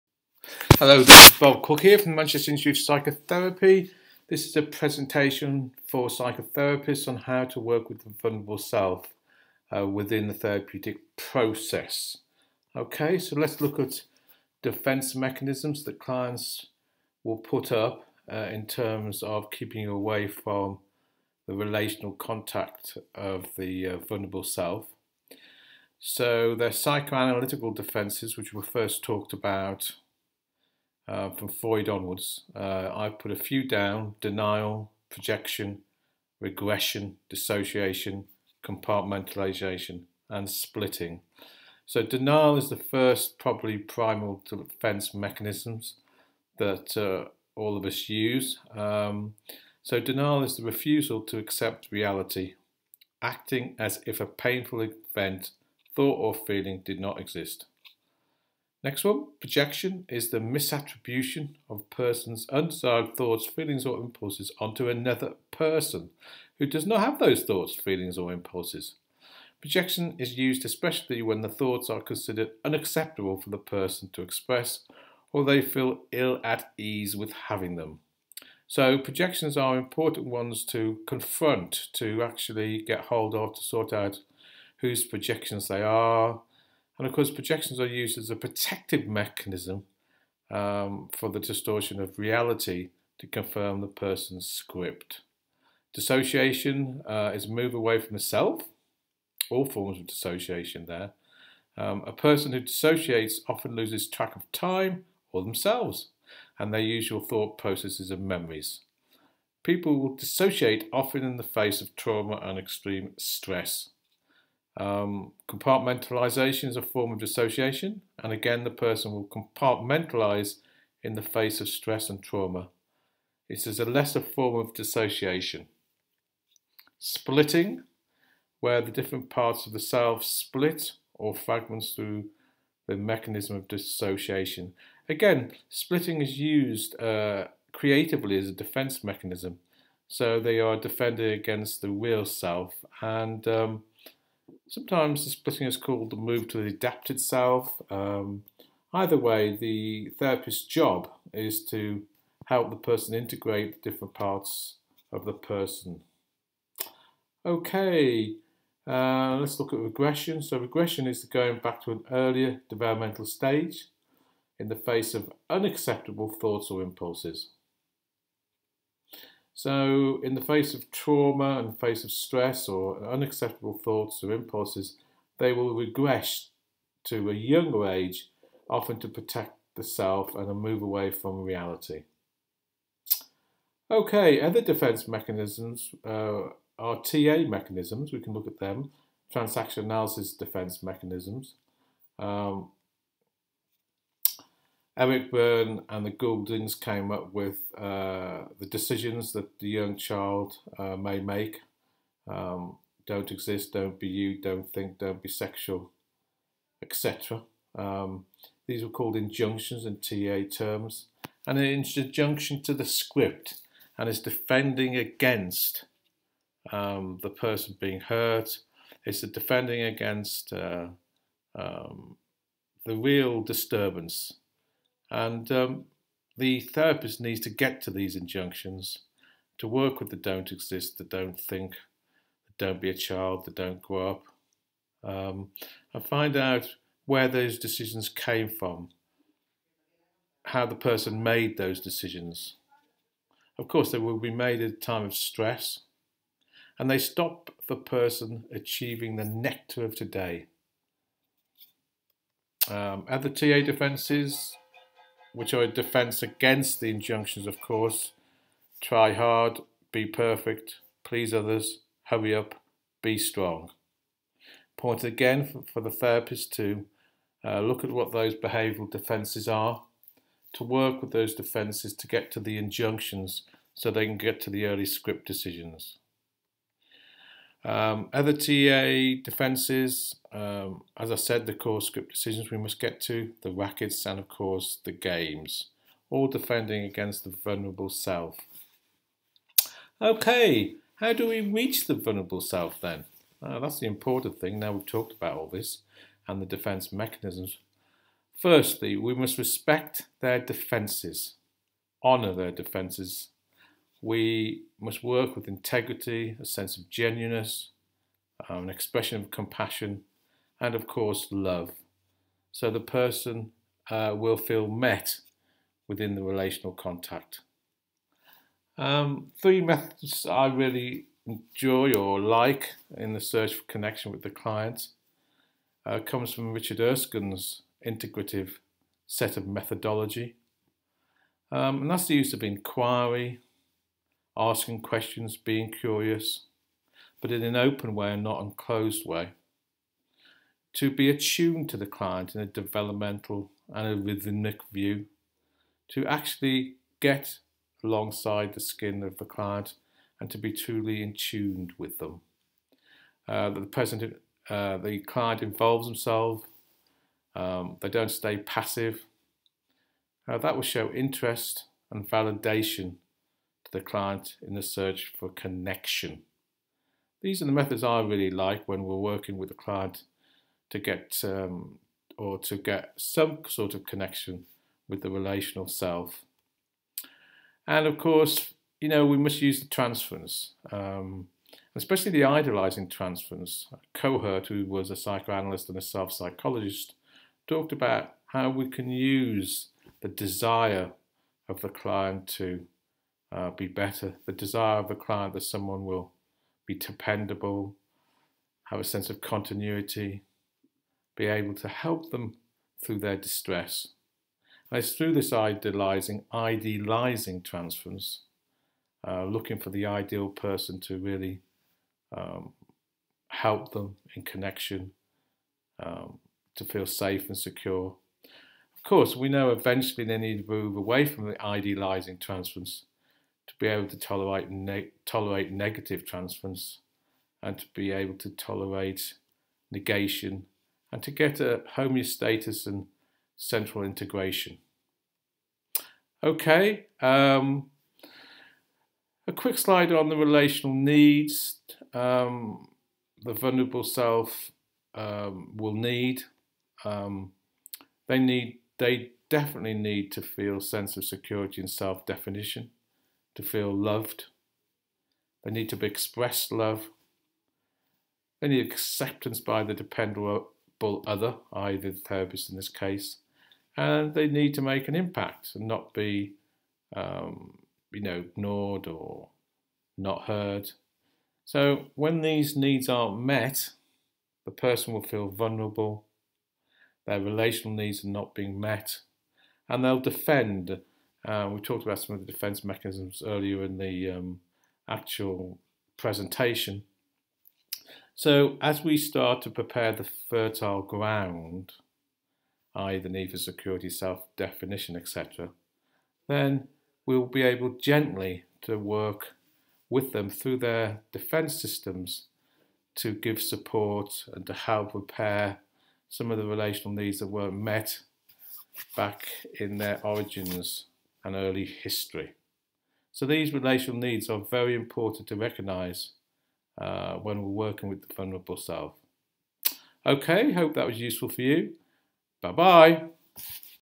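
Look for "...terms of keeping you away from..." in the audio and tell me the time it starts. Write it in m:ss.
0:18.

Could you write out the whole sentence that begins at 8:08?
So as we start to prepare the fertile ground, i.e.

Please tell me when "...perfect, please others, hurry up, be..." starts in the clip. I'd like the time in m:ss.
4:20.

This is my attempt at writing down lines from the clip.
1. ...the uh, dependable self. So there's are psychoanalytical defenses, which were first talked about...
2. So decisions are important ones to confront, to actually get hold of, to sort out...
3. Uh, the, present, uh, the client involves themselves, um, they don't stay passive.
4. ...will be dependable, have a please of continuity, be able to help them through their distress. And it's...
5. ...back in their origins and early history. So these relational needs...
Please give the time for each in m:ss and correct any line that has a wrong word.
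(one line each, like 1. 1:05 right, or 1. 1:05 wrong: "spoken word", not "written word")
1. 0:23 wrong: "vulnerable", not "dependable"
2. 1:18 wrong: "projections", not "decisions"
3. 5:53 right
4. 6:35 wrong: "sense", not "please"
5. 8:28 right.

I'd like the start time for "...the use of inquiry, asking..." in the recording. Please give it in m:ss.
5:32.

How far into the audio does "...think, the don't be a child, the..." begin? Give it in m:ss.
3:51.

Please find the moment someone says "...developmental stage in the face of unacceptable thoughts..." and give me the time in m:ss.
2:42.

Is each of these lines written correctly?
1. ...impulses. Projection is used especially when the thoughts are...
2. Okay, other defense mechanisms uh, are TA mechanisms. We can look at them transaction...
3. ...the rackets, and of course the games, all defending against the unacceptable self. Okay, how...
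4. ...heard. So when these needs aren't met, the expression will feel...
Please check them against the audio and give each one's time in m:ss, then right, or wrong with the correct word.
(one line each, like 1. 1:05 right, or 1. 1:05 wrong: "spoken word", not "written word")
1. 1:08 right
2. 3:03 right
3. 4:43 wrong: "vulnerable", not "unacceptable"
4. 7:50 wrong: "person", not "expression".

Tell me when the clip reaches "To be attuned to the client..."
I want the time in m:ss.
5:40.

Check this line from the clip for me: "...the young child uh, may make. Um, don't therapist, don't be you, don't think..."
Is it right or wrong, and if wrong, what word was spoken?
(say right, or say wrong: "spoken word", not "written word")
wrong: "exist", not "therapist".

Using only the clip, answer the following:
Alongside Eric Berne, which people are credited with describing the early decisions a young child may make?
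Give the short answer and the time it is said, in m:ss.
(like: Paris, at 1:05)
The Gouldings, at 3:16.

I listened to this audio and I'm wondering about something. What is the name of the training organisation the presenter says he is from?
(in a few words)
Manchester Institute of Psychotherapy.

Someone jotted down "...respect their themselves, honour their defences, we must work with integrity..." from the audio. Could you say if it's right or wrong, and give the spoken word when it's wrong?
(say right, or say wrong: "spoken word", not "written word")
wrong: "defences", not "themselves".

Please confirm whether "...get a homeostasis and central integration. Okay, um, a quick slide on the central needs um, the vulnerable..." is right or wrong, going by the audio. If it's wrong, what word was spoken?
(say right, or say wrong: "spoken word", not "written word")
wrong: "relational", not "central".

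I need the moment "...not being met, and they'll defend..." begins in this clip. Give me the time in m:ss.
7:58.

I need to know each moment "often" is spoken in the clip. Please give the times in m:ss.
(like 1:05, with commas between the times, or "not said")
1:43, 1:50, 2:58.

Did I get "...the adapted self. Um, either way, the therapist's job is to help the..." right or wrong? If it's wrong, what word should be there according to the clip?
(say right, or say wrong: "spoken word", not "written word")
right.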